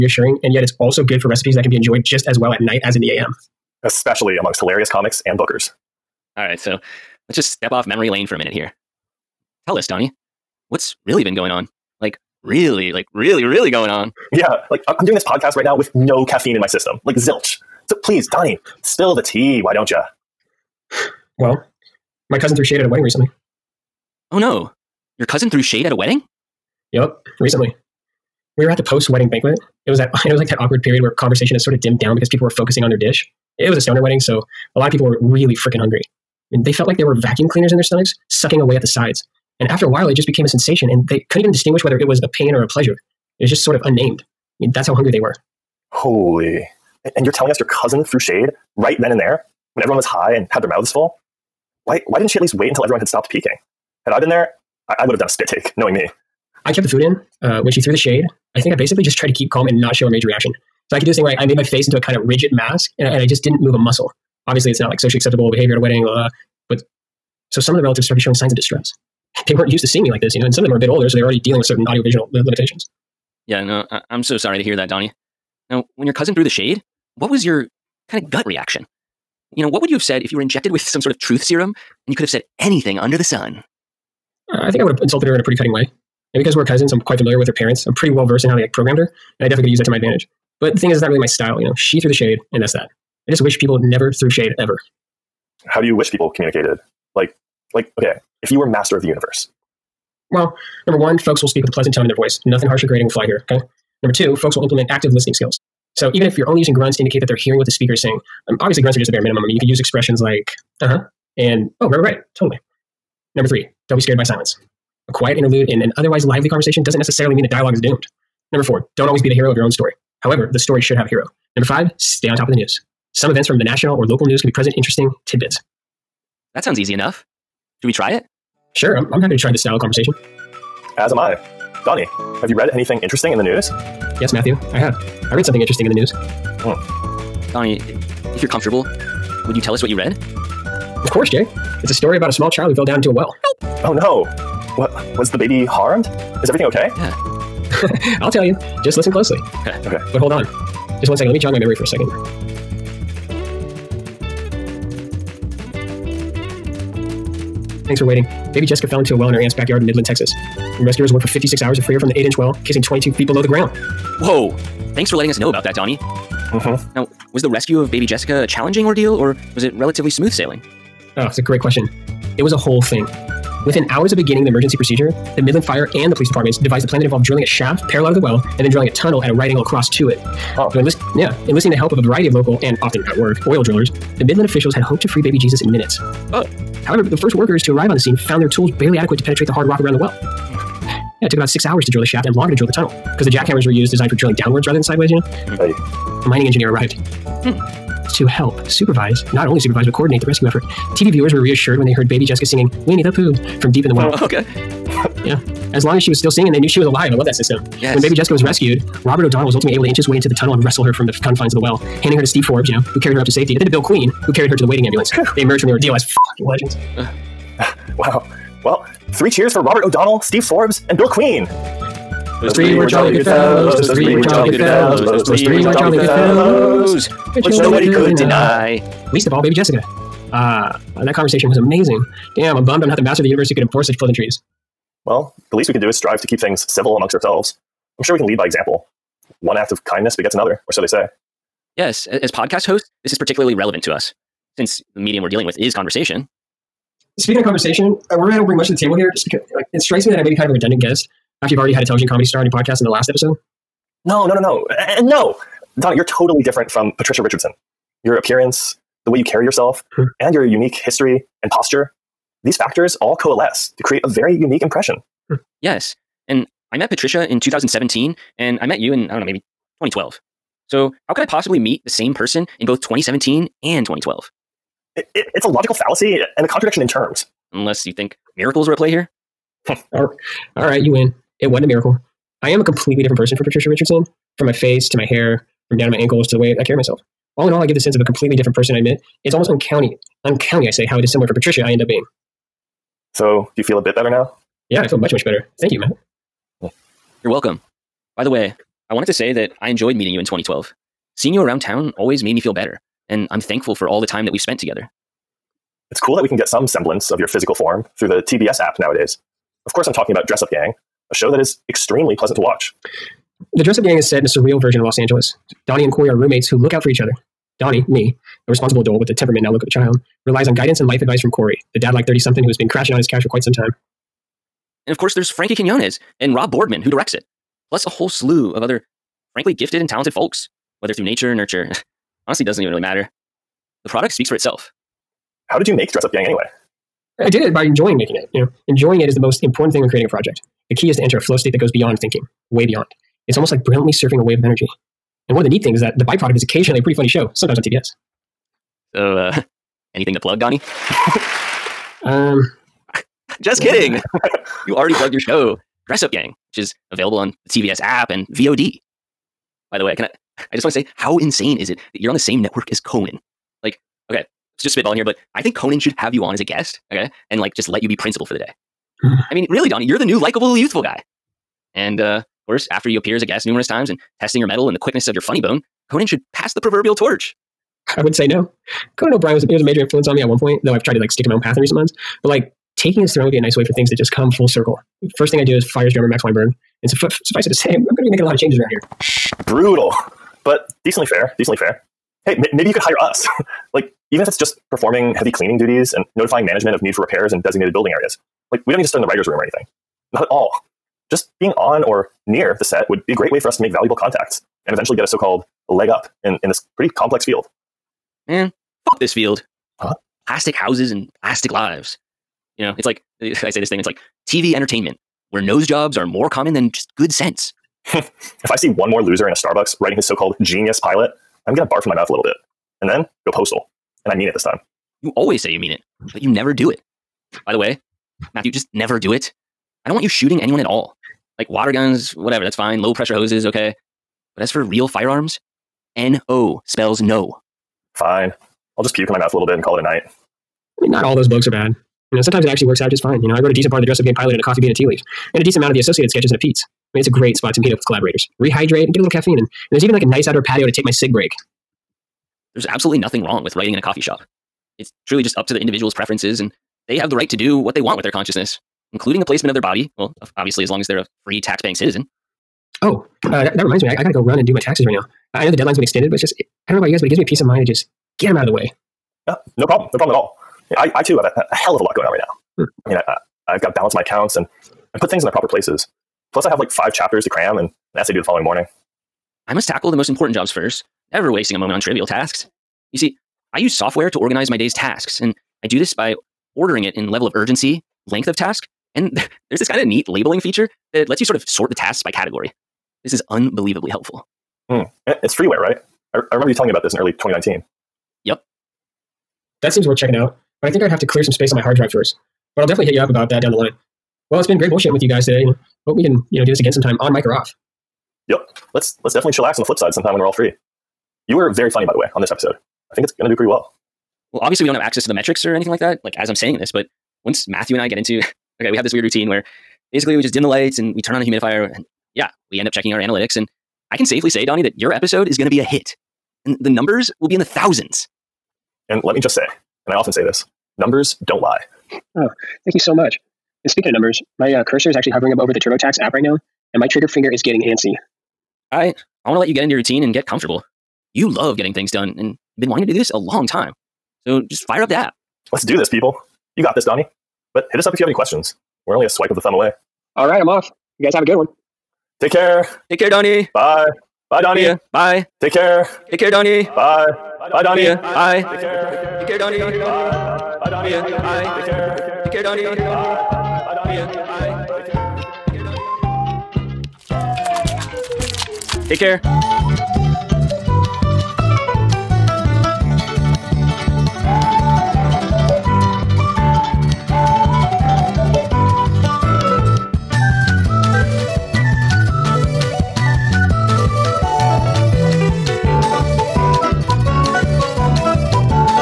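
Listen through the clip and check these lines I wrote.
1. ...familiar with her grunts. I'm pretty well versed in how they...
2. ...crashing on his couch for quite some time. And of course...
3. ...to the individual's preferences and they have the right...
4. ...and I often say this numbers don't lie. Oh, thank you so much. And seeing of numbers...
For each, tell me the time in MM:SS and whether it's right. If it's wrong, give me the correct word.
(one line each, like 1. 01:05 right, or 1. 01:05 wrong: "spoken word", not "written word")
1. 01:27 wrong: "parents", not "grunts"
2. 05:22 right
3. 07:35 right
4. 08:49 wrong: "speaking", not "seeing".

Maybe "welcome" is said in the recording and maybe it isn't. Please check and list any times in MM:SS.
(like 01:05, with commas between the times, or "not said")
04:57.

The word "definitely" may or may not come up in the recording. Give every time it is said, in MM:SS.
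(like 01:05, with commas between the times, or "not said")
01:29, 08:22, 08:29.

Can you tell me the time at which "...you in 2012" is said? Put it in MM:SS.
05:00.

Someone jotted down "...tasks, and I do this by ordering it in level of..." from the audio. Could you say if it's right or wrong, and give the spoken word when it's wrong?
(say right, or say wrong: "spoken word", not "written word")
right.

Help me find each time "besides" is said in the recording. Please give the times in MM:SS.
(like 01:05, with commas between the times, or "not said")
not said.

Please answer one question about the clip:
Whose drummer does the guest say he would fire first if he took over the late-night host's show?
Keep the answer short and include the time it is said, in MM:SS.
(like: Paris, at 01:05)
Max Weinberg, at 06:26.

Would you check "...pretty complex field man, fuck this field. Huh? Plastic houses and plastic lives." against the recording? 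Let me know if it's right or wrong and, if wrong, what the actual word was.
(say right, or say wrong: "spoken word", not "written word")
right.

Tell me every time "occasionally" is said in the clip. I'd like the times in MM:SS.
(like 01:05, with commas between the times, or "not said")
05:46.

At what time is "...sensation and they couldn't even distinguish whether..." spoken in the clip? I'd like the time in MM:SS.
00:40.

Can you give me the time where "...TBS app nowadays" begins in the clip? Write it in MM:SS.
05:08.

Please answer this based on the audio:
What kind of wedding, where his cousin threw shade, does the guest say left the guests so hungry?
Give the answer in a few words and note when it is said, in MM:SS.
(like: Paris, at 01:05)
A stoner wedding, at 00:33.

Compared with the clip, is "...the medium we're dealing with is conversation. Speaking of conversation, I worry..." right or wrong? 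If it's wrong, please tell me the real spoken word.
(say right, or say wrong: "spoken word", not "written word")
right.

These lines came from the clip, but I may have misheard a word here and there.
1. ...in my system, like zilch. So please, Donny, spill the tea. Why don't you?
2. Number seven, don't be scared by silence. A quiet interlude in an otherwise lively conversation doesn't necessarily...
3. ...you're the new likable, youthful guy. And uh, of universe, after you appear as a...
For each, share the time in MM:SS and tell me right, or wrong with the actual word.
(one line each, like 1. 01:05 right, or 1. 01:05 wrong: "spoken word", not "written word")
1. 00:16 right
2. 01:53 wrong: "three", not "seven"
3. 06:09 wrong: "course", not "universe".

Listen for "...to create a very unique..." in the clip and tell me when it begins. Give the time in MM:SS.
04:23.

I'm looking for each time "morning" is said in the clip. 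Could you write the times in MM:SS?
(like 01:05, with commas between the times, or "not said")
07:58.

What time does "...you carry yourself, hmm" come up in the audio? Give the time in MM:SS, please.
04:19.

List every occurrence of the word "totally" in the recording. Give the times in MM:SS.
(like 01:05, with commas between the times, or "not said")
01:52, 04:16.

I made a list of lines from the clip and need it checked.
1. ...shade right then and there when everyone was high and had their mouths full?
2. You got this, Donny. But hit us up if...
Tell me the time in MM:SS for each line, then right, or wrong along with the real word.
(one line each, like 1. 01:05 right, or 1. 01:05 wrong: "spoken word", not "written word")
1. 00:48 right
2. 09:06 right.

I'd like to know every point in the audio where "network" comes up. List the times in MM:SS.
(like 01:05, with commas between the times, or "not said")
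06:02.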